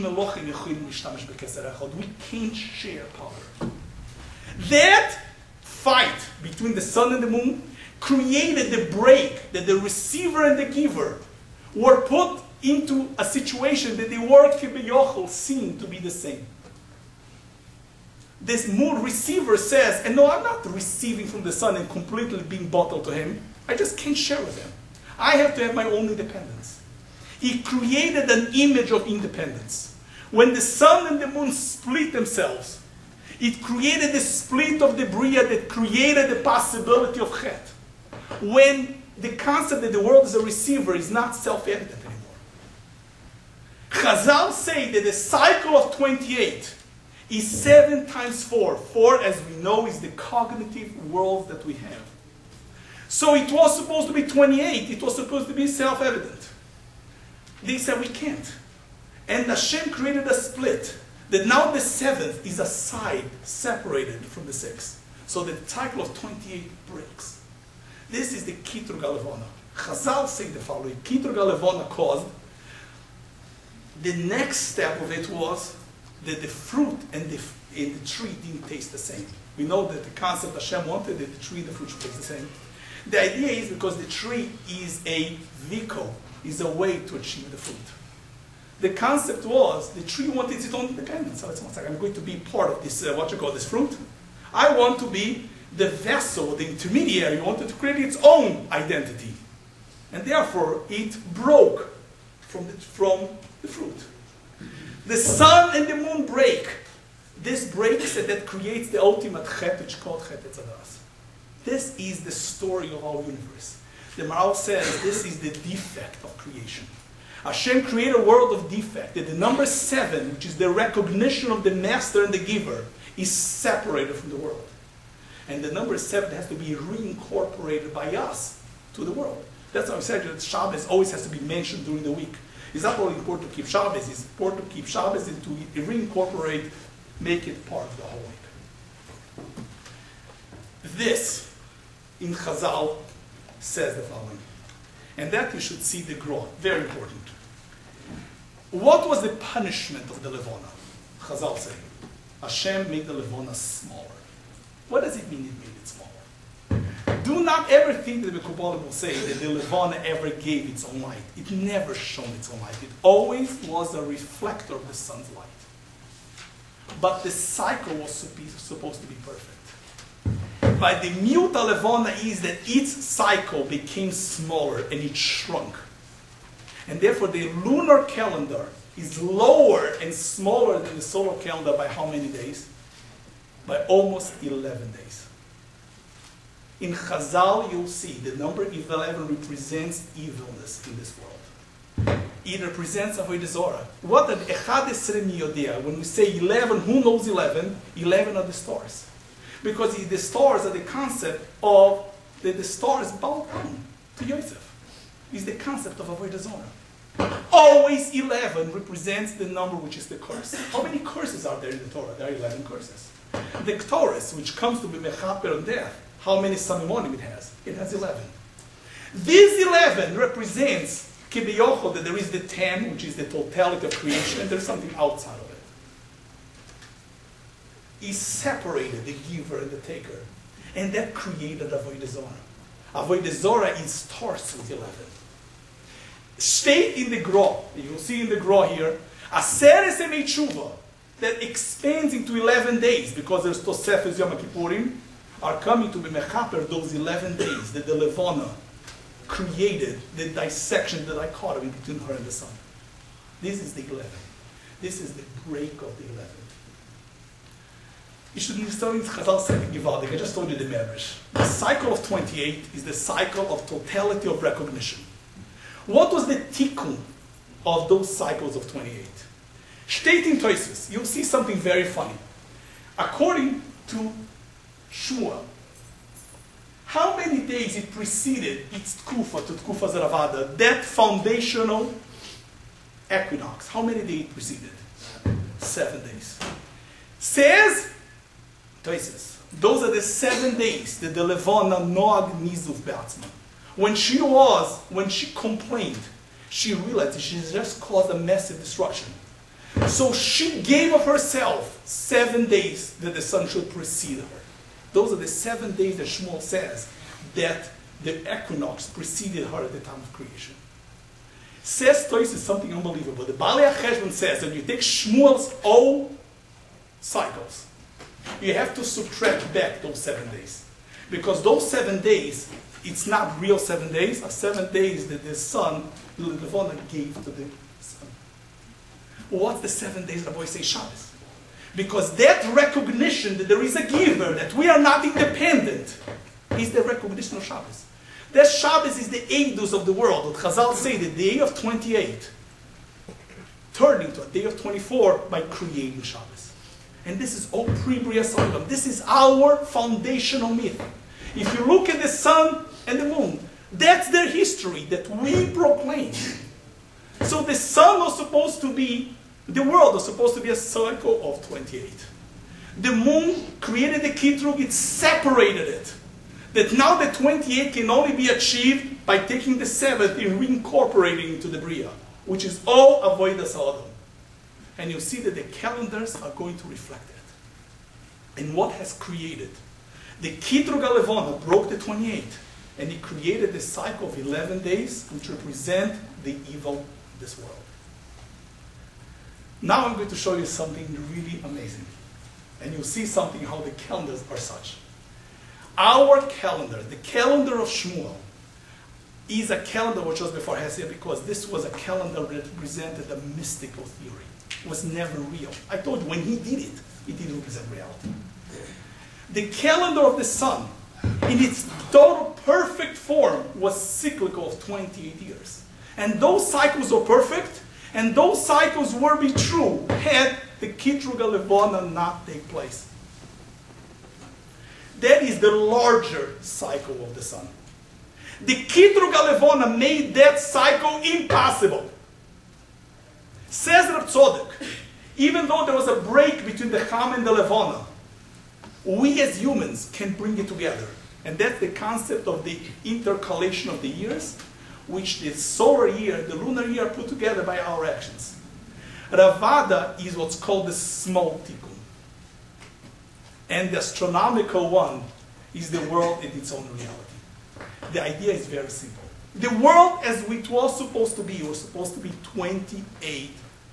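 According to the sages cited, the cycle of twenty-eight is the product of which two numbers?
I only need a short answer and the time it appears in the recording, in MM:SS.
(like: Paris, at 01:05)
7 times 4, at 00:47.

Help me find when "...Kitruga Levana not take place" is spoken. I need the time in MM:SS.
07:00.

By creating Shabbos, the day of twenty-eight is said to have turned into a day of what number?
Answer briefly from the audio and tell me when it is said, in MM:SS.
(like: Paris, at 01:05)
24, at 05:44.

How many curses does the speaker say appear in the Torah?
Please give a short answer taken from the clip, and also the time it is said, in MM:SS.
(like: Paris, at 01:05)
11, at 03:32.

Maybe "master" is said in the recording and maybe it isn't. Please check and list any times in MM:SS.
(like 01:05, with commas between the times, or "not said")
02:01.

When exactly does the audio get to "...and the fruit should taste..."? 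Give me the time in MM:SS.
01:21.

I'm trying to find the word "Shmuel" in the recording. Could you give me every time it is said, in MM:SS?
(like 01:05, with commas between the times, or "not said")
05:06, 05:14, 06:37.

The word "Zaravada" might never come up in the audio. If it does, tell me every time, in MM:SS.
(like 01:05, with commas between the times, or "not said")
04:39.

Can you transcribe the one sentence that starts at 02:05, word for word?
And the number seven has to be reincorporated by us to the world.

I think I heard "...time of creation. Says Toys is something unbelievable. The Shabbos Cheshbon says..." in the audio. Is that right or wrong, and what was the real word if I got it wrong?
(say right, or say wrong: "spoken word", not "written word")
wrong: "Baalei", not "Shabbos".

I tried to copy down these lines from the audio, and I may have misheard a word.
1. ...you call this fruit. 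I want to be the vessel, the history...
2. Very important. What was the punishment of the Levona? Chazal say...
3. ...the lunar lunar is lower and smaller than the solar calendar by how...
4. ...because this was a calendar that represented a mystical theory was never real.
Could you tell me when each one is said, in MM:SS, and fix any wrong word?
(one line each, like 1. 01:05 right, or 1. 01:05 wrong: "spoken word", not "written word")
1. 01:33 wrong: "intermediary", not "history"
2. 02:26 right
3. 02:57 wrong: "calendar", not "lunar"
4. 06:40 right.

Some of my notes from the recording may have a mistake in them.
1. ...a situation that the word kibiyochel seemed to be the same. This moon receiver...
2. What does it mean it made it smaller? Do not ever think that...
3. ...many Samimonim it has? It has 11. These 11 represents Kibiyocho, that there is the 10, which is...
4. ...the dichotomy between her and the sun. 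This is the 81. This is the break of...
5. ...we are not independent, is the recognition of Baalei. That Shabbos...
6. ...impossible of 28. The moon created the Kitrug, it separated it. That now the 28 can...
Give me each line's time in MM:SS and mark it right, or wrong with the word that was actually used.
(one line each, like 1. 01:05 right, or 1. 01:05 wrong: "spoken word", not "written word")
1. 00:13 right
2. 02:34 right
3. 03:36 right
4. 04:11 wrong: "11", not "81"
5. 05:34 wrong: "Shabbos", not "Baalei"
6. 06:00 wrong: "circle", not "impossible".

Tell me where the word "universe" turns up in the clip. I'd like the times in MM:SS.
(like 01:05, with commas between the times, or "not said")
01:53.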